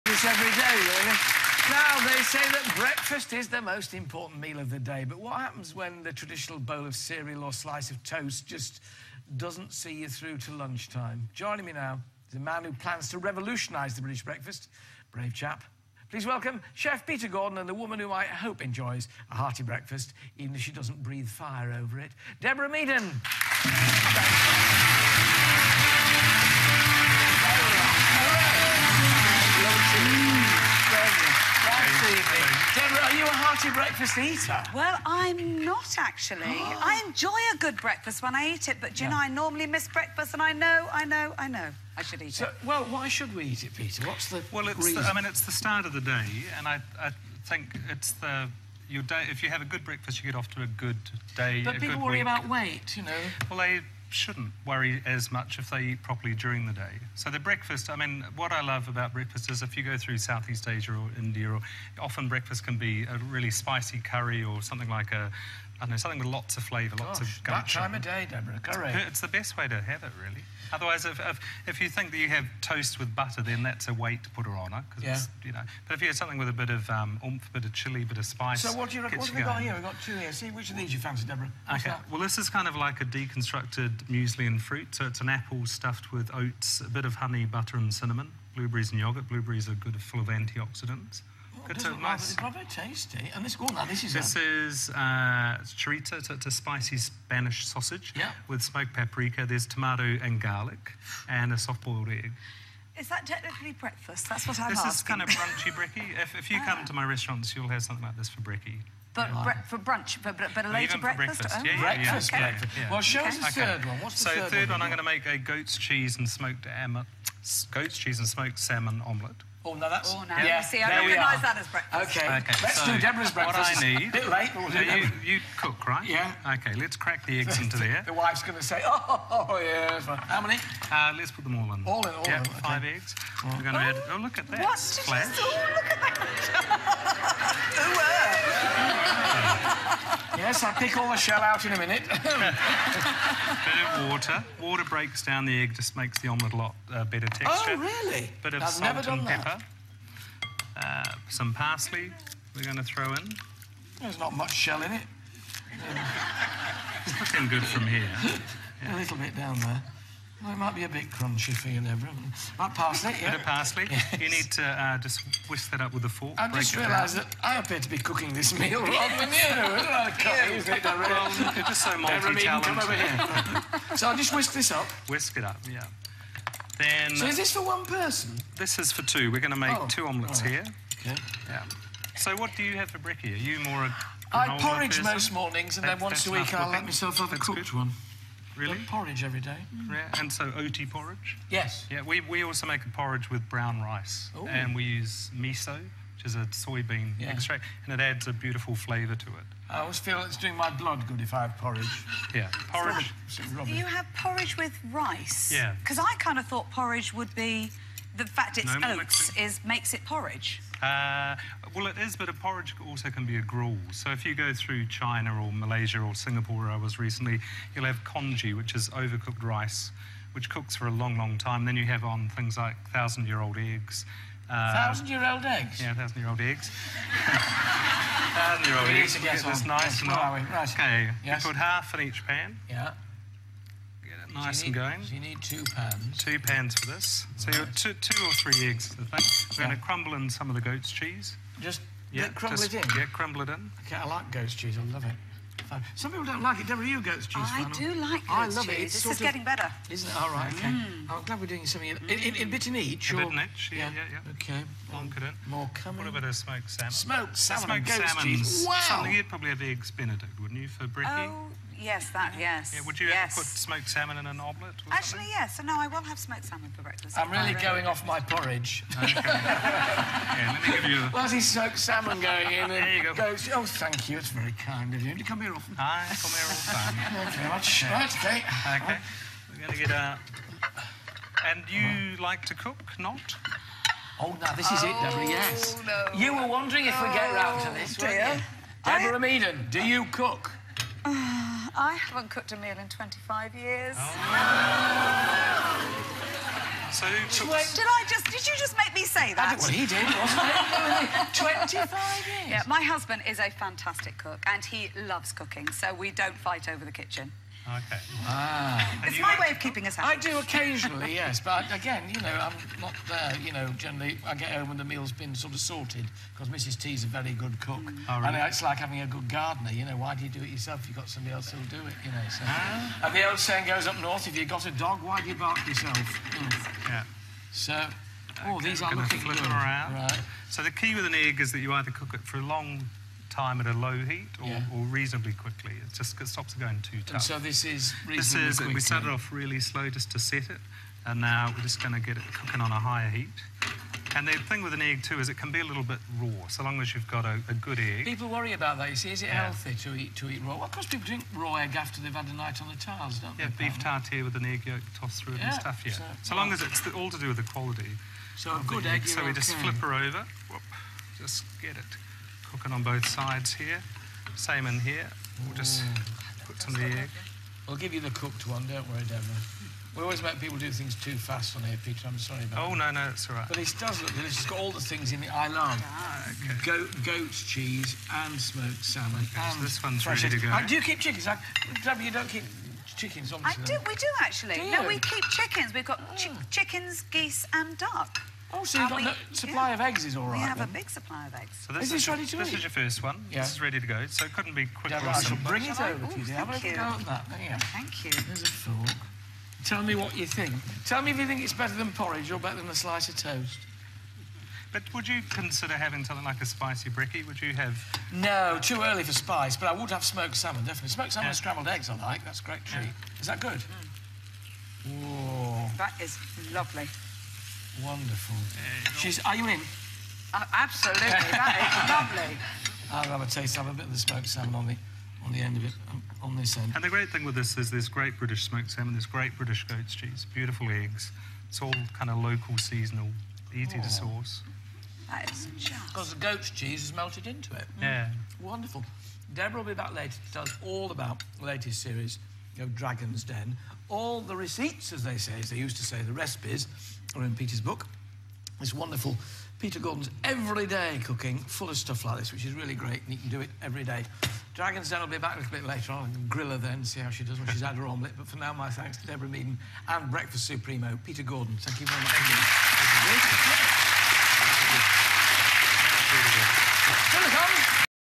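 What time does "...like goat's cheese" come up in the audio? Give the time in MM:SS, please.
04:04.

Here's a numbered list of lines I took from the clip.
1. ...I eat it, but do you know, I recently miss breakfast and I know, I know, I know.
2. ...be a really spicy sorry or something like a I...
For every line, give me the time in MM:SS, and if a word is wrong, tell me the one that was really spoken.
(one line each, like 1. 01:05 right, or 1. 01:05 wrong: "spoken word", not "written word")
1. 00:38 wrong: "normally", not "recently"
2. 01:02 wrong: "curry", not "sorry".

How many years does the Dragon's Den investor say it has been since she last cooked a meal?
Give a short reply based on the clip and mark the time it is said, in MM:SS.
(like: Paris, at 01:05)
25 years, at 04:52.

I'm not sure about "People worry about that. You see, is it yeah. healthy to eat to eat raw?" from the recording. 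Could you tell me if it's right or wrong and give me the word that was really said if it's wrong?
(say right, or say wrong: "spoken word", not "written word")
right.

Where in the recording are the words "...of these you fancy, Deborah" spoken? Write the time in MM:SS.
01:20.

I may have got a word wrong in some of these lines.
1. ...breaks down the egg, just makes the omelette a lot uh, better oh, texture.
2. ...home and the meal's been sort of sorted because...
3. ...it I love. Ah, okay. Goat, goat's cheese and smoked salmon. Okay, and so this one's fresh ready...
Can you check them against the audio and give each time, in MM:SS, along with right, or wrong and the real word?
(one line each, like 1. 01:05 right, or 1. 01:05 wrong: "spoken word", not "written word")
1. 02:24 right
2. 05:14 right
3. 06:15 right.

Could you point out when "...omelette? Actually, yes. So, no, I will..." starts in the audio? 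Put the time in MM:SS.
04:24.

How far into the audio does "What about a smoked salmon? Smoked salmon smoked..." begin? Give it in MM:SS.
04:16.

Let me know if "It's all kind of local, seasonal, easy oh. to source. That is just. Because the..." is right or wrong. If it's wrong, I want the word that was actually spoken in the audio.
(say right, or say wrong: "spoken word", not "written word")
right.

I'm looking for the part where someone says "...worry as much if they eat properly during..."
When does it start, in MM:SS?
00:54.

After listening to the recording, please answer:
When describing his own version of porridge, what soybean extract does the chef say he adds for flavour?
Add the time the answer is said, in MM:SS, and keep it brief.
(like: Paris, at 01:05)
Miso, at 03:15.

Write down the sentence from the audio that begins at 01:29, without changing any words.
Blueberries are good, full of antioxidants.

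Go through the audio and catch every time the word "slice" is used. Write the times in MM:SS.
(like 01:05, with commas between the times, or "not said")
00:07, 06:42.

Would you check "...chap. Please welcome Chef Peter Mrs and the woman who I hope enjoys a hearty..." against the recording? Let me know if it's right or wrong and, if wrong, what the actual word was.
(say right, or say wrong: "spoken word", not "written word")
wrong: "Gordon", not "Mrs".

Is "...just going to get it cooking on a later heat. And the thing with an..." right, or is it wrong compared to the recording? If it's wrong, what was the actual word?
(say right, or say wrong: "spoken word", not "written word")
wrong: "higher", not "later".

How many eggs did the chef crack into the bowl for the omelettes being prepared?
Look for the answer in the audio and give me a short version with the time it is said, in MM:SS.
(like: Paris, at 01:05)
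5, at 02:12.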